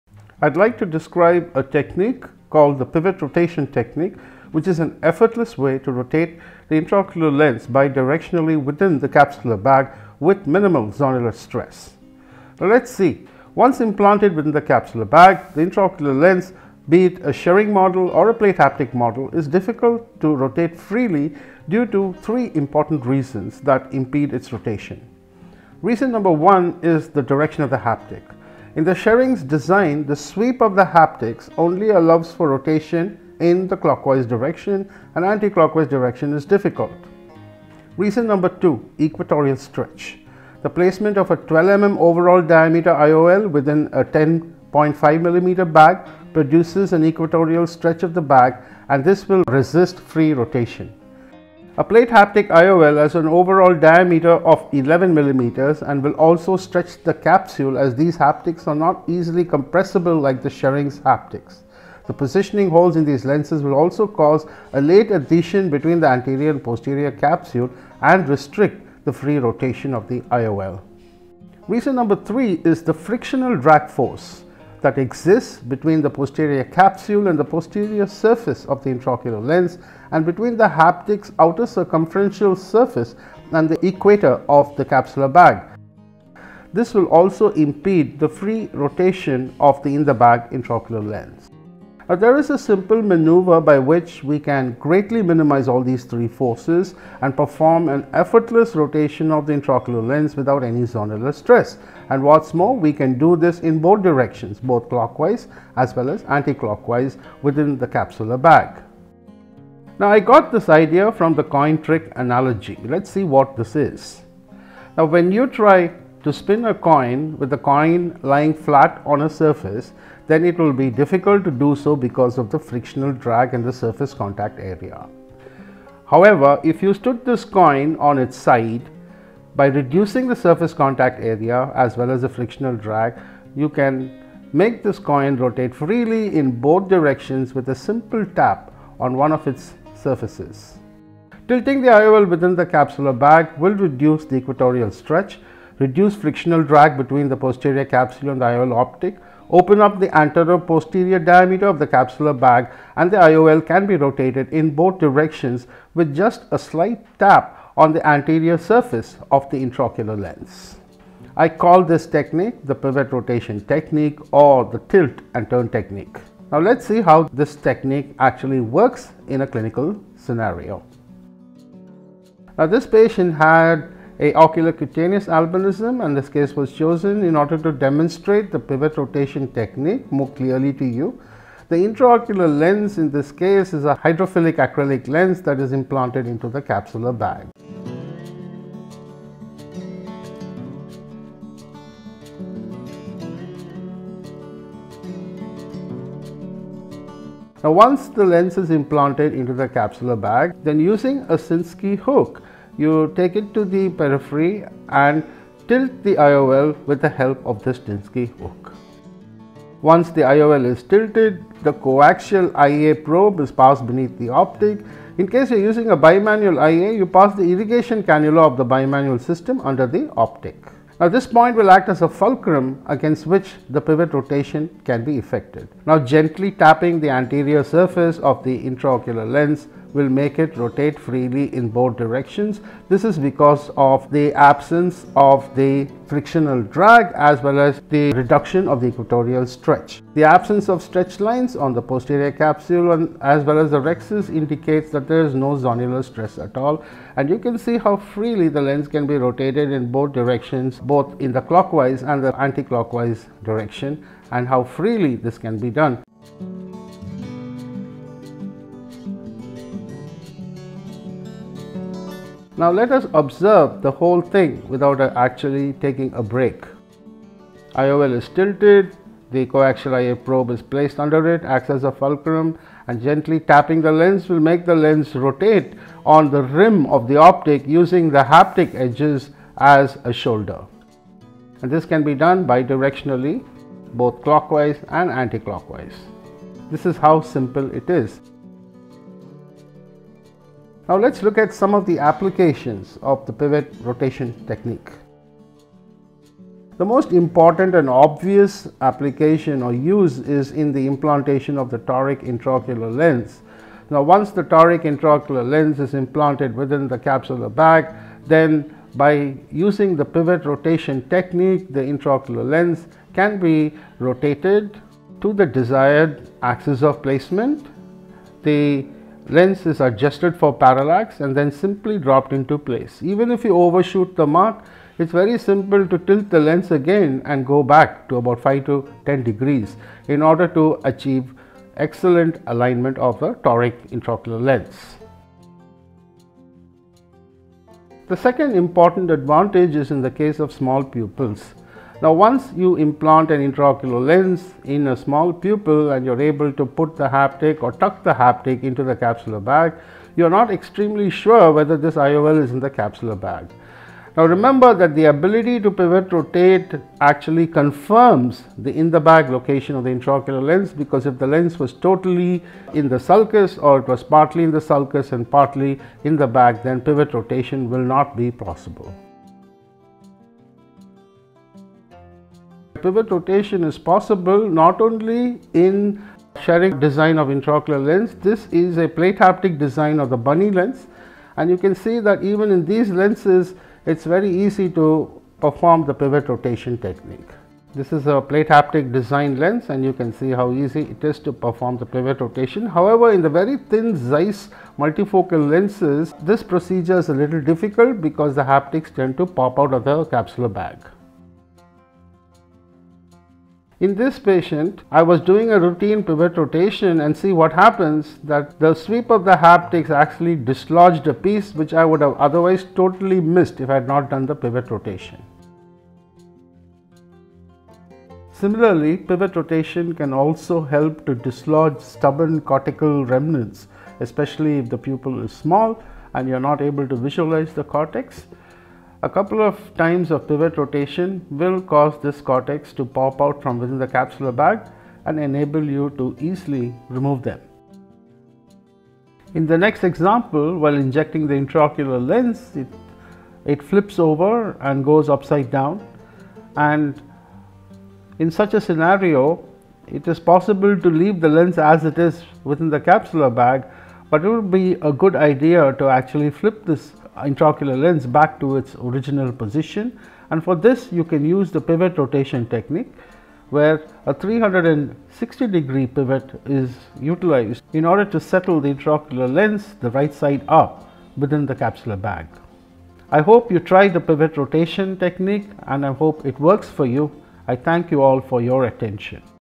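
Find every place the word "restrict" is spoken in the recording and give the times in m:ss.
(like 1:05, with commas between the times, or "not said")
1:08.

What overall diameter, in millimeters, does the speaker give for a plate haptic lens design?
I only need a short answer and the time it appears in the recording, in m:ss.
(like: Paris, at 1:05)
11, at 0:54.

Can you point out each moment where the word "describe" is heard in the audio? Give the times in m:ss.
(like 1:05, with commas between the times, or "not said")
0:00.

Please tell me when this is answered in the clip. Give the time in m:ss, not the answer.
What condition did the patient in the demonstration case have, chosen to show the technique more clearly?
2:54.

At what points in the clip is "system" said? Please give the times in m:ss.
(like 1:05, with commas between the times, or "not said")
3:39.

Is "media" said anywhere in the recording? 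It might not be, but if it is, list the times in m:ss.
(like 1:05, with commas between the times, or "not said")
not said.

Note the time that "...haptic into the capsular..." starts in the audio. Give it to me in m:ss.
5:48.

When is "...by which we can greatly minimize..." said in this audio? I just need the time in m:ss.
1:33.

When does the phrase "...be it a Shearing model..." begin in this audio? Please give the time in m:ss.
0:16.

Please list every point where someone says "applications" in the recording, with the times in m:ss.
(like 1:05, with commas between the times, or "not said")
4:51, 4:58.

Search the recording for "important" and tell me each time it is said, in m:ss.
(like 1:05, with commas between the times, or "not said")
0:22, 4:57, 5:38.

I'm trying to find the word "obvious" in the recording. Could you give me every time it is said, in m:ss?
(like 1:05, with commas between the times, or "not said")
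4:57.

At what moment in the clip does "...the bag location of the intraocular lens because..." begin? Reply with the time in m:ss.
5:58.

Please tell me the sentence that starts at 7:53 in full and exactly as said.
I hope you try the pivot rotation technique and I hope it works for you.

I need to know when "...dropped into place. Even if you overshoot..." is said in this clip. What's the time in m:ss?
5:21.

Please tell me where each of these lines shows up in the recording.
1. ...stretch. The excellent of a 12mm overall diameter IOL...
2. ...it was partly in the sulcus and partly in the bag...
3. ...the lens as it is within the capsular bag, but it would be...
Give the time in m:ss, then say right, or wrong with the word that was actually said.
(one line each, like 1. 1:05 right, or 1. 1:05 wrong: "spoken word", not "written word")
1. 0:39 wrong: "placement", not "excellent"
2. 6:03 right
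3. 7:31 right.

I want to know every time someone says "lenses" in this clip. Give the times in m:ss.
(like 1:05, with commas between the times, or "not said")
1:03, 6:22, 6:35.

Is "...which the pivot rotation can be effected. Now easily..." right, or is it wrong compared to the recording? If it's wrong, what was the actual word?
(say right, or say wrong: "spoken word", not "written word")
wrong: "gently", not "easily".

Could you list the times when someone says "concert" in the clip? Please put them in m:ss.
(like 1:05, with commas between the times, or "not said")
not said.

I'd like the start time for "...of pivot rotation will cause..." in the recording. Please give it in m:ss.
7:10.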